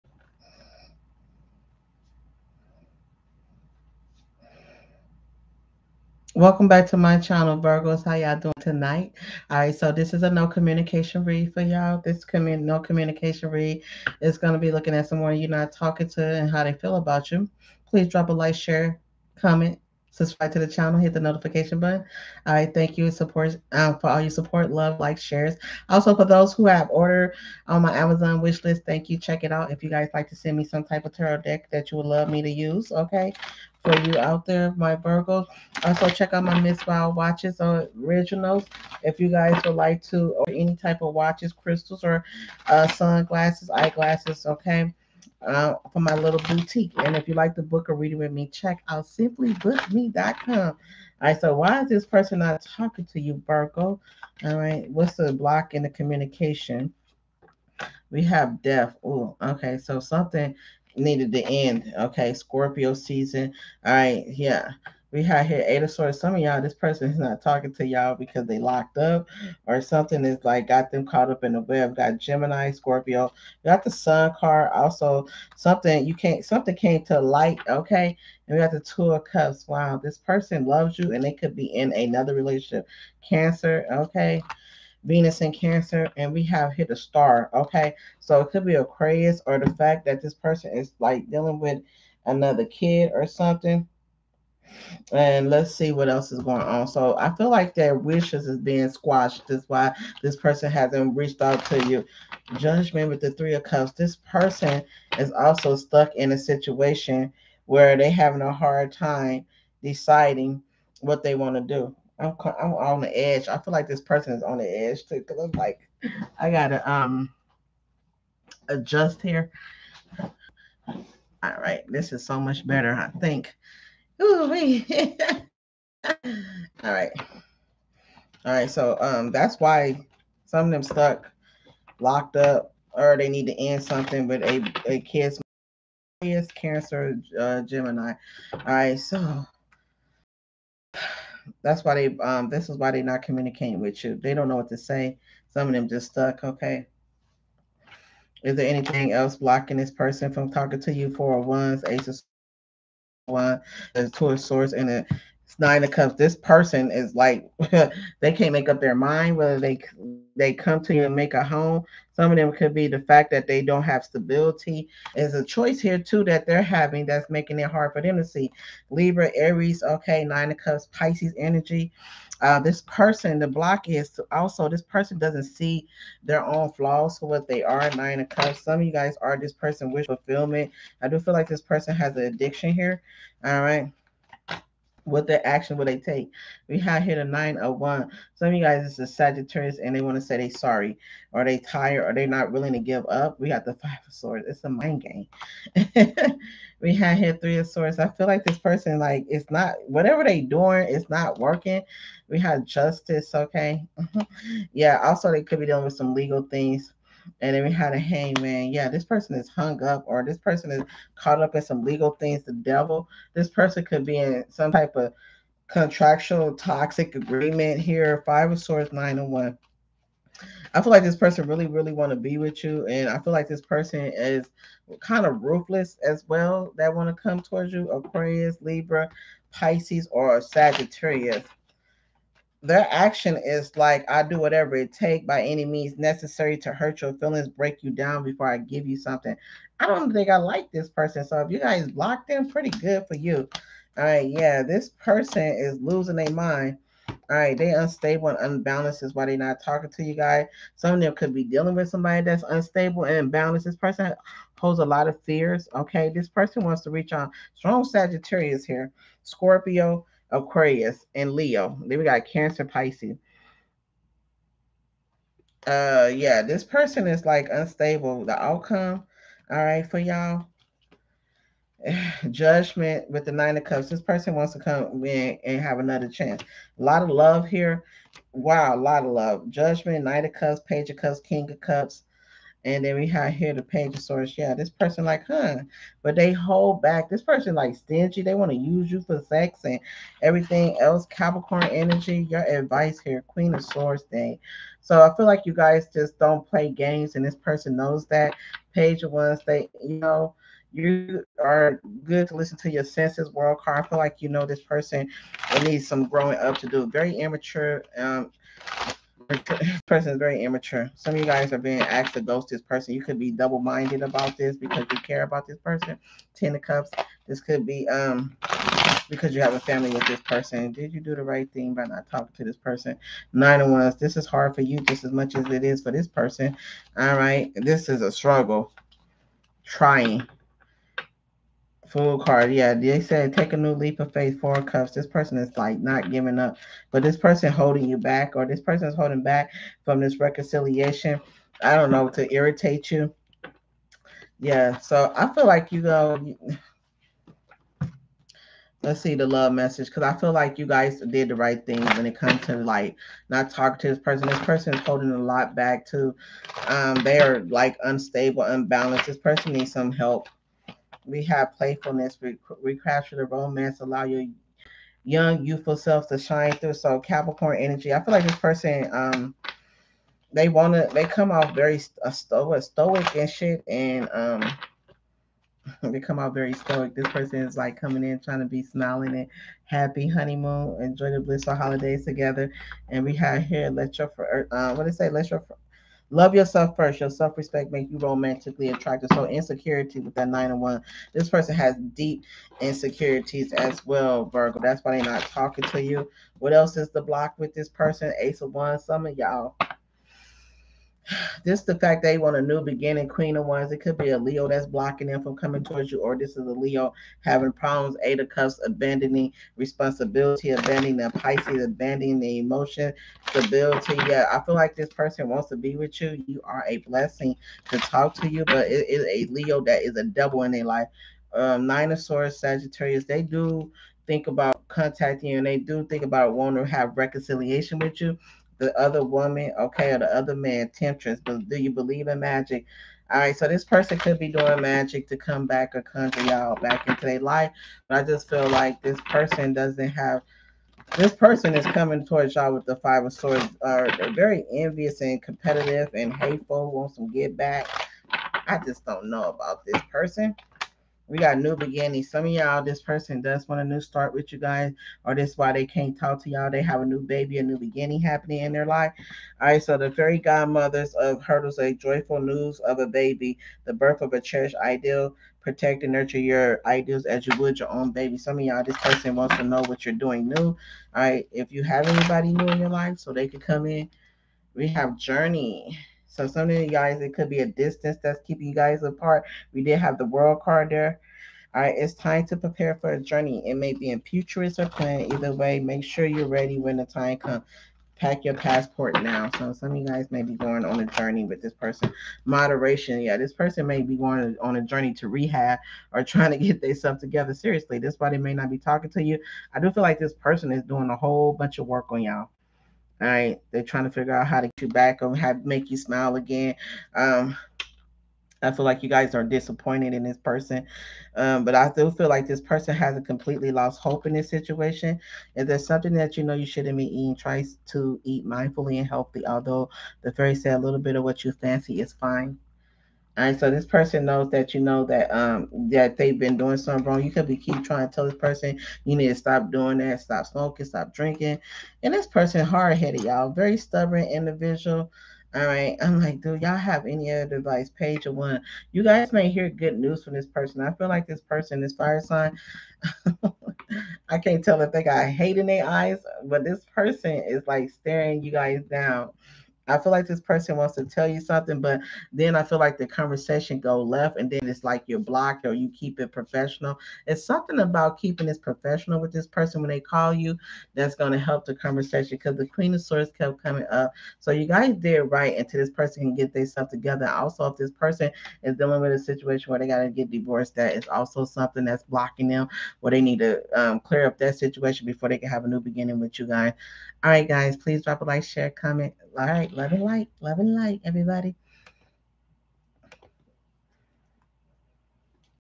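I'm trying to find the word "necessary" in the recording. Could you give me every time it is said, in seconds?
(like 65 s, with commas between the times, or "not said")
235 s.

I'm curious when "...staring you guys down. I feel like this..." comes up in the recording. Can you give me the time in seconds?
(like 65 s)
547 s.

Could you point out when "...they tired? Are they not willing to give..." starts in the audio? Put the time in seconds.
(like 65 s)
191 s.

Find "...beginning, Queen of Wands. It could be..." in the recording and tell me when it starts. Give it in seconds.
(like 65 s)
402 s.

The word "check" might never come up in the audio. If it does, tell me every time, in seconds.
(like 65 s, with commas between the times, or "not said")
29 s, 36 s, 48 s.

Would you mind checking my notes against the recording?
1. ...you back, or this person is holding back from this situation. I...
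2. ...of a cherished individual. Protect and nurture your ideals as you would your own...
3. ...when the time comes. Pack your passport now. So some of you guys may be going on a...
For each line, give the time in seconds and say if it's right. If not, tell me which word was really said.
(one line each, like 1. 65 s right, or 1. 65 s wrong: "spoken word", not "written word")
1. 337 s wrong: "reconciliation", not "situation"
2. 464 s wrong: "ideal", not "individual"
3. 486 s right.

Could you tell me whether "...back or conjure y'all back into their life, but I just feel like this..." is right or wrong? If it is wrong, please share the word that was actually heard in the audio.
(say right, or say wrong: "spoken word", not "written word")
right.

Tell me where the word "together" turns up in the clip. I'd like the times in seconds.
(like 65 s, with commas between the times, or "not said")
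382 s, 496 s, 566 s.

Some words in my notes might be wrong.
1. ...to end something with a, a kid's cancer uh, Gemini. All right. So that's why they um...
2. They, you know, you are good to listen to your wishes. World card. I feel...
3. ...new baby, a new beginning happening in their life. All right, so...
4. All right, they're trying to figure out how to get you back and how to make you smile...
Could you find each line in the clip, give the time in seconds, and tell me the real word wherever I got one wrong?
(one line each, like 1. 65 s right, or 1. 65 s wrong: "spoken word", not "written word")
1. 133 s right
2. 299 s wrong: "senses", not "wishes"
3. 456 s right
4. 503 s right.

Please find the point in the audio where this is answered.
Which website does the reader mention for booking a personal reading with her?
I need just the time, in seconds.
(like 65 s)
49 s.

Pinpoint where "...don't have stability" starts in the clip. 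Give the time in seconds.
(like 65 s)
163 s.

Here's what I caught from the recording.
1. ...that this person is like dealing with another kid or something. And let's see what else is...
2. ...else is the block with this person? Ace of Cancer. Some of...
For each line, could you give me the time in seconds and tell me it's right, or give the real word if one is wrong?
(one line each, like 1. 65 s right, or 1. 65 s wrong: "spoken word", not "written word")
1. 90 s right
2. 396 s wrong: "Wands", not "Cancer".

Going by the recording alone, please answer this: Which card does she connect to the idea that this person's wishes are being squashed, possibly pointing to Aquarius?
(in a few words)
Star.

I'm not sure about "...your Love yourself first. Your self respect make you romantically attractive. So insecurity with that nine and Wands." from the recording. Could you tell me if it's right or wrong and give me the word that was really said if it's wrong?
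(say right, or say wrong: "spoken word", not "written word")
right.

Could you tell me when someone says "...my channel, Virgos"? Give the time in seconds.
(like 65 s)
6 s.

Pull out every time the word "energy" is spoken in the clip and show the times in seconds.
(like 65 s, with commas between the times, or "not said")
171 s, 291 s, 367 s.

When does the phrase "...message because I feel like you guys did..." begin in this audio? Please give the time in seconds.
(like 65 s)
349 s.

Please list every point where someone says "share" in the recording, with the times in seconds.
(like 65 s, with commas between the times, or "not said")
18 s, 25 s, 578 s.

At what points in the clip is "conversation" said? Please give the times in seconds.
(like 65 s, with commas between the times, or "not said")
552 s, 561 s.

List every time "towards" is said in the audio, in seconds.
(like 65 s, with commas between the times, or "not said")
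227 s, 405 s, 442 s.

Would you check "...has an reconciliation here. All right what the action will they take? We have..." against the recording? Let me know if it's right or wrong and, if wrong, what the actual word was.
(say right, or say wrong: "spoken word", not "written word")
wrong: "addiction", not "reconciliation".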